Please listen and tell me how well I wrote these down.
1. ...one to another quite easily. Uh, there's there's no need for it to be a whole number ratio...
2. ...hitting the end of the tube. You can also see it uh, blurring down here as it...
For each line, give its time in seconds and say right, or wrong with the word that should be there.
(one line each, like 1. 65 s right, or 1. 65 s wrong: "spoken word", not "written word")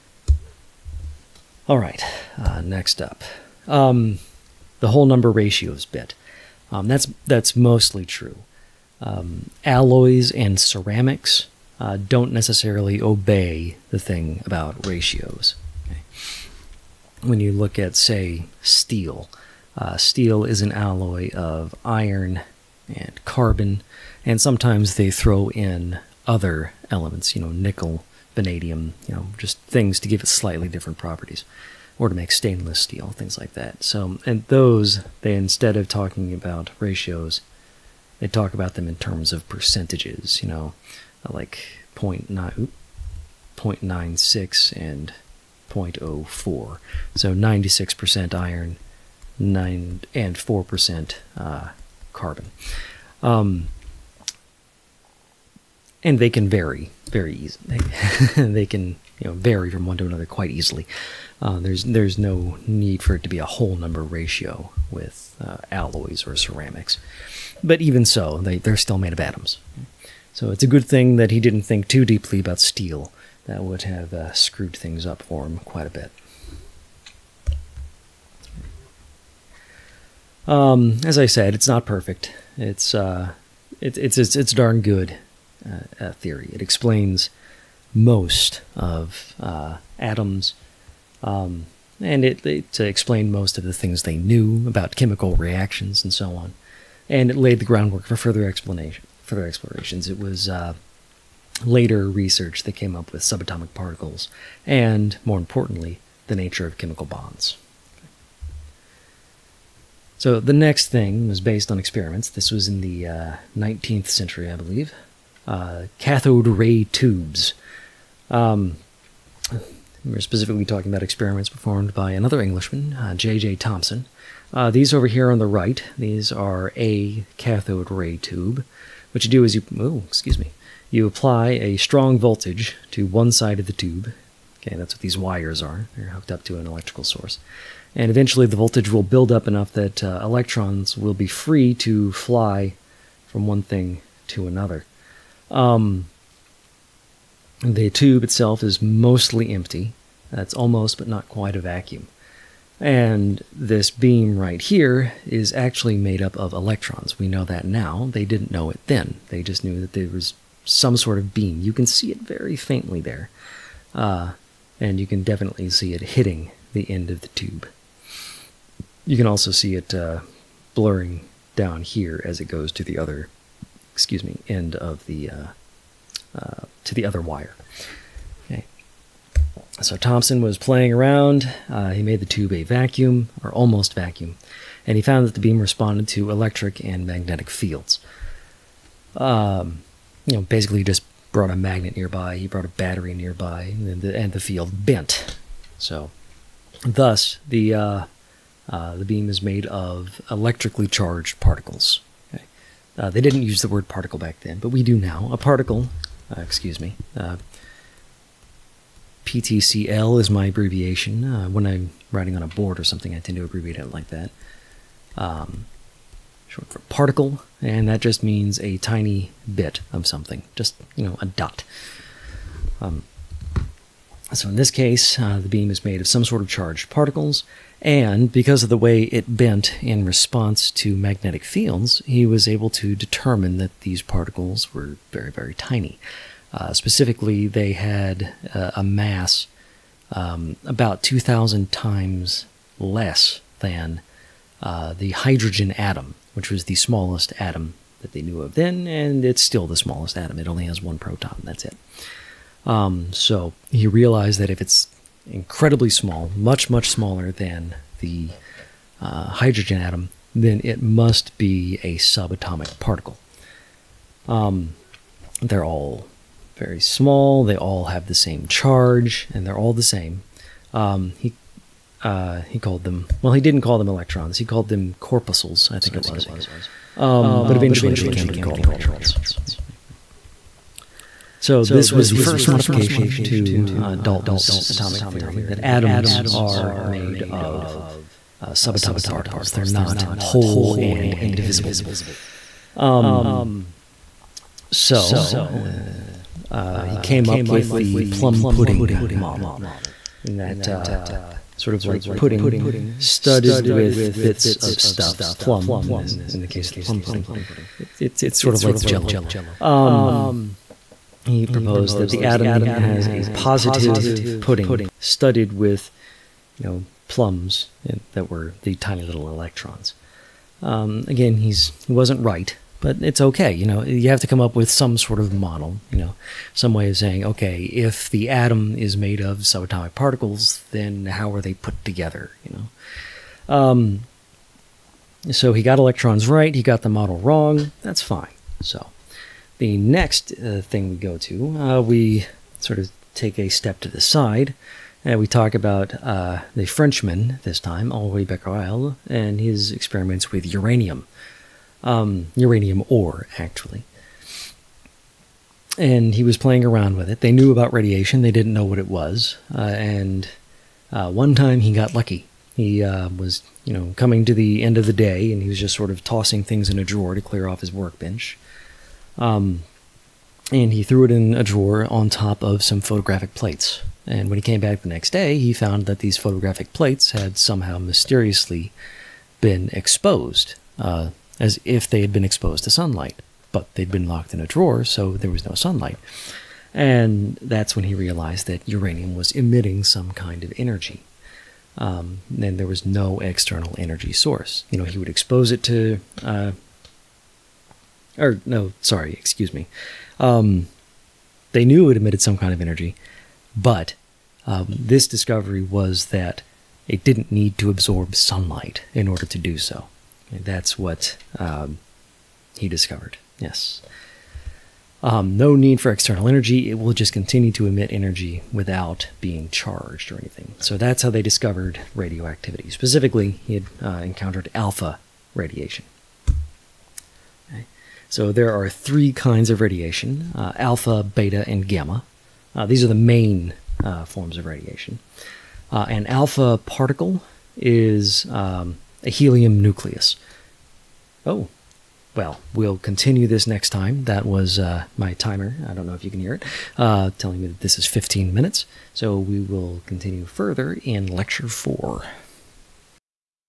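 1. 59 s right
2. 166 s right.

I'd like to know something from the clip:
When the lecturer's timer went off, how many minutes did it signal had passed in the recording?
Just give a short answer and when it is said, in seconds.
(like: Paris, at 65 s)
15 minutes, at 447 s.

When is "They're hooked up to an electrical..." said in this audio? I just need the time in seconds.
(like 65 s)
135 s.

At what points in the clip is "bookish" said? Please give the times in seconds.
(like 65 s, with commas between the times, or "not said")
not said.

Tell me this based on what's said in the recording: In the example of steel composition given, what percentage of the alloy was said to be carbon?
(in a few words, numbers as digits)
4%.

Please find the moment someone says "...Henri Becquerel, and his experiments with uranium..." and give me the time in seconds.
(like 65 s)
347 s.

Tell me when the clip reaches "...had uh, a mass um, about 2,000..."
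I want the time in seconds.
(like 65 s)
237 s.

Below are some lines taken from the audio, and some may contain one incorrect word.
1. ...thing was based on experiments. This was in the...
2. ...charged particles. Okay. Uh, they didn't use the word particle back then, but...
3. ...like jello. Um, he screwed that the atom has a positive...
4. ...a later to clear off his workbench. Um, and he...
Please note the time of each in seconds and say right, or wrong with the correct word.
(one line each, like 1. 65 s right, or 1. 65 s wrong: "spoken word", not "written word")
1. 110 s right
2. 200 s right
3. 308 s wrong: "proposed", not "screwed"
4. 366 s wrong: "drawer", not "later".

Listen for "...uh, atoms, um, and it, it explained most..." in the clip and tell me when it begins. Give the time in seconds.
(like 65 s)
89 s.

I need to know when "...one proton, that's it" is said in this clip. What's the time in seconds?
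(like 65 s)
250 s.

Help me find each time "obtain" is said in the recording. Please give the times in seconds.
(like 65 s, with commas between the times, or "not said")
not said.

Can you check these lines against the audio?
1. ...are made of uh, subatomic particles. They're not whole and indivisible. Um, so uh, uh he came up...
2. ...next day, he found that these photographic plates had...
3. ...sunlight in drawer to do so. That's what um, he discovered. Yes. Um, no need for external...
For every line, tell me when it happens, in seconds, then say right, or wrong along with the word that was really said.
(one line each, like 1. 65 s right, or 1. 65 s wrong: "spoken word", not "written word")
1. 286 s right
2. 374 s right
3. 408 s wrong: "order", not "drawer".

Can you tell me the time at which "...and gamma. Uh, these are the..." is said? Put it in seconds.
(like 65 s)
431 s.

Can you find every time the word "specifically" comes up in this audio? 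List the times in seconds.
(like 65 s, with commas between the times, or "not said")
120 s, 236 s, 422 s.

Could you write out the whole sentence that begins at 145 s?
Um, the tube itself is mostly empty.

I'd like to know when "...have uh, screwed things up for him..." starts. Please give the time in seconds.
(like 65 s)
73 s.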